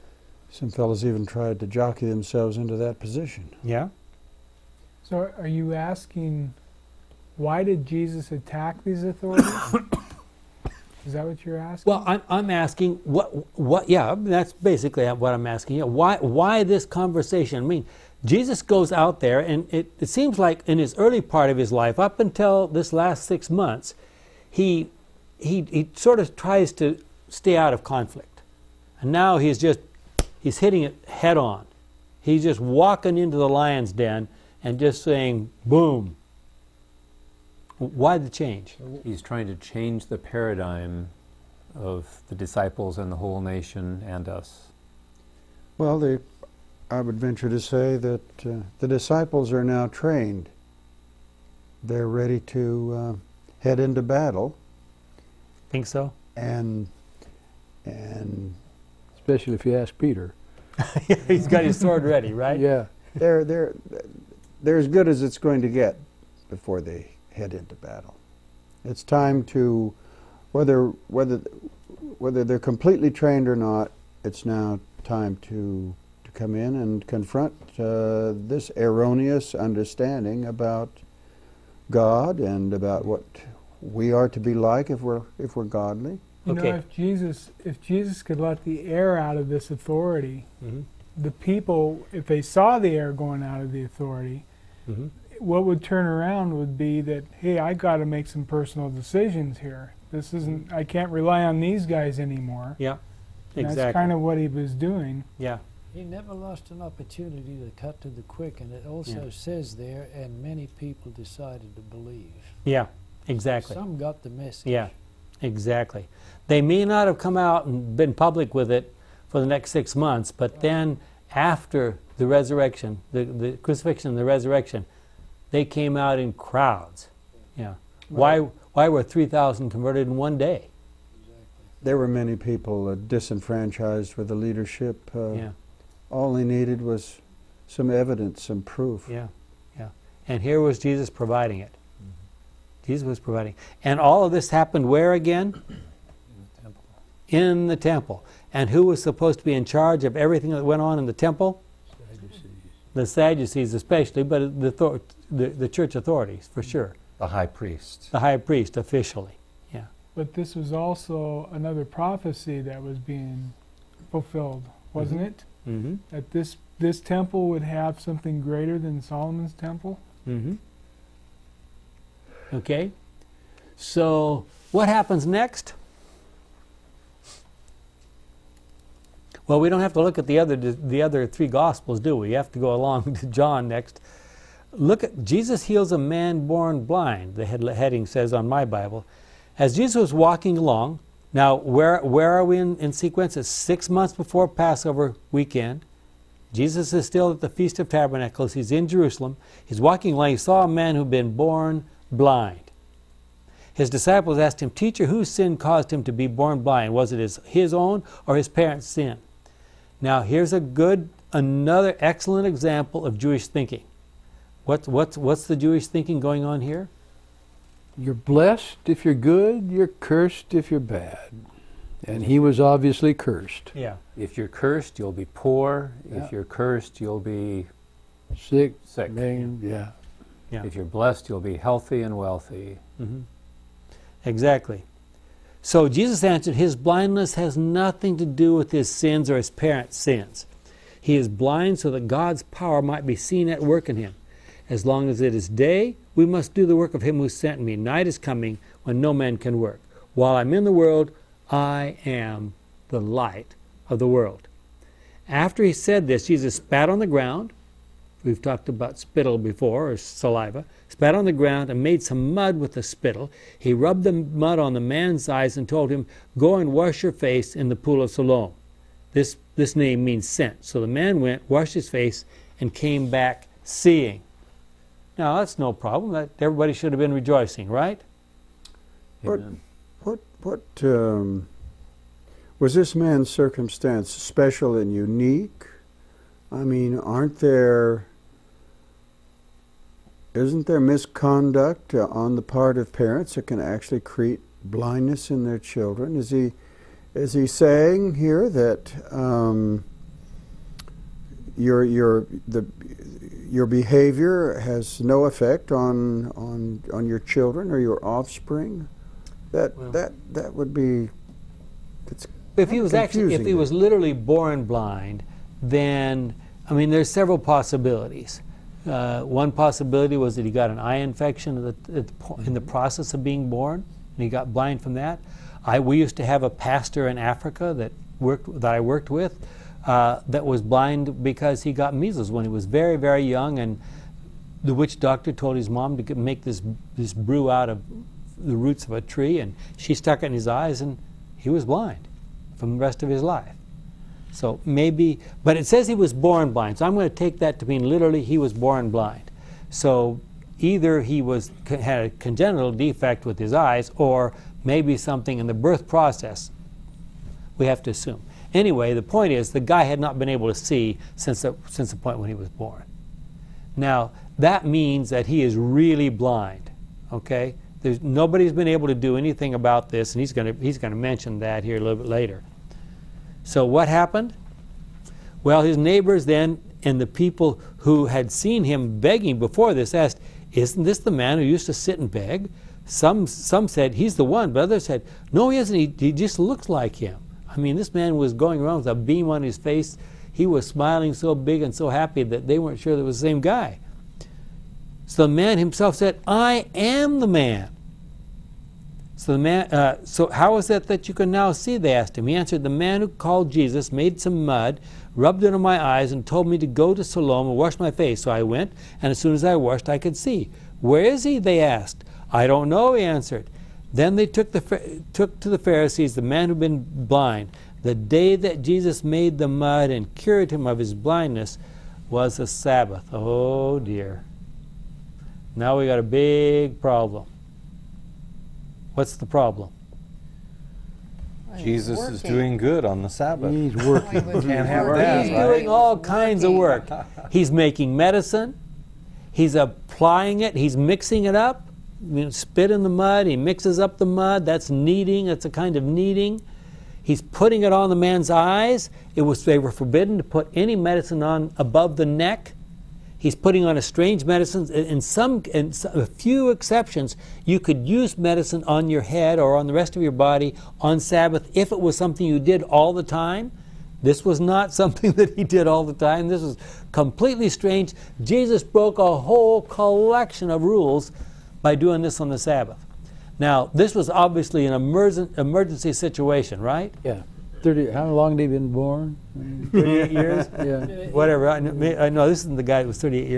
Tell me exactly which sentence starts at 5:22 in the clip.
process of being born, and he got blind from that.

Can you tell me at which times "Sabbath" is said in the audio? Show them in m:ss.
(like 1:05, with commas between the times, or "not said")
7:02, 7:13, 7:40, 7:52.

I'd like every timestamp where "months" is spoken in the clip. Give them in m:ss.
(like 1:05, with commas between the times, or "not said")
0:23, 1:59, 3:13.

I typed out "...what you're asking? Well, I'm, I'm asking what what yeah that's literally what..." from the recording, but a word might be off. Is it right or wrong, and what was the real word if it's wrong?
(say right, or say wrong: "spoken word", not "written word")
wrong: "basically", not "literally".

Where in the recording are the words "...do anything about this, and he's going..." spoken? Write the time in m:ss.
6:08.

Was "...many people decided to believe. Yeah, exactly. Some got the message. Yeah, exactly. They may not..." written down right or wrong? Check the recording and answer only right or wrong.
right.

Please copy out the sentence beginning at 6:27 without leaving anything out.
I mean, this man was going around with a beam on his face.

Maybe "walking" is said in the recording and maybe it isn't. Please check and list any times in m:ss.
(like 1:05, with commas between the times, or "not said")
0:32, 3:10, 3:19.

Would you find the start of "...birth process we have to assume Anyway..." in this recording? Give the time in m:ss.
5:55.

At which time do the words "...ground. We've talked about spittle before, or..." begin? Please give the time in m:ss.
4:17.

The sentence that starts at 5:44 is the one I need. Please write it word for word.
So maybe, but it says he was born blind, so I'm going to take that to mean literally he was born blind.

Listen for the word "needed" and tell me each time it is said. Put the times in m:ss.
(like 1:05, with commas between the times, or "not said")
2:16.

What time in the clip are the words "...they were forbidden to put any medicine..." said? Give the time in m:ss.
7:29.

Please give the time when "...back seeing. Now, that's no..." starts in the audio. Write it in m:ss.
4:33.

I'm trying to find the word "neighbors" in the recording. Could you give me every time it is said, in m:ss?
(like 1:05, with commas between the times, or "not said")
6:15.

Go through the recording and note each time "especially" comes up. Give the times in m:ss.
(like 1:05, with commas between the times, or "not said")
0:59, 2:33.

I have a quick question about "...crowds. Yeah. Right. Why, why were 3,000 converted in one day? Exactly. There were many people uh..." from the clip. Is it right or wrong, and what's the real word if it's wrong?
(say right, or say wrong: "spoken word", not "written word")
right.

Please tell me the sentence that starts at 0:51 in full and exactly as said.
They're ready to uh, head into battle.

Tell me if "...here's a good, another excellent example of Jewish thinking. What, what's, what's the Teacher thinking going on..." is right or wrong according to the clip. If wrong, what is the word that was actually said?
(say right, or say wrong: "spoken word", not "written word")
wrong: "Jewish", not "Teacher".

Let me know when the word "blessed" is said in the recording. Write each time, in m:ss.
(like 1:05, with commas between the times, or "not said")
3:38, 3:50.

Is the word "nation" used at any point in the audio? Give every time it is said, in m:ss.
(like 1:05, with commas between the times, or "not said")
0:43.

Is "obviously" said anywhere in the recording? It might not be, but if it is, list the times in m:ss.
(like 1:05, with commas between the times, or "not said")
3:42, 7:54.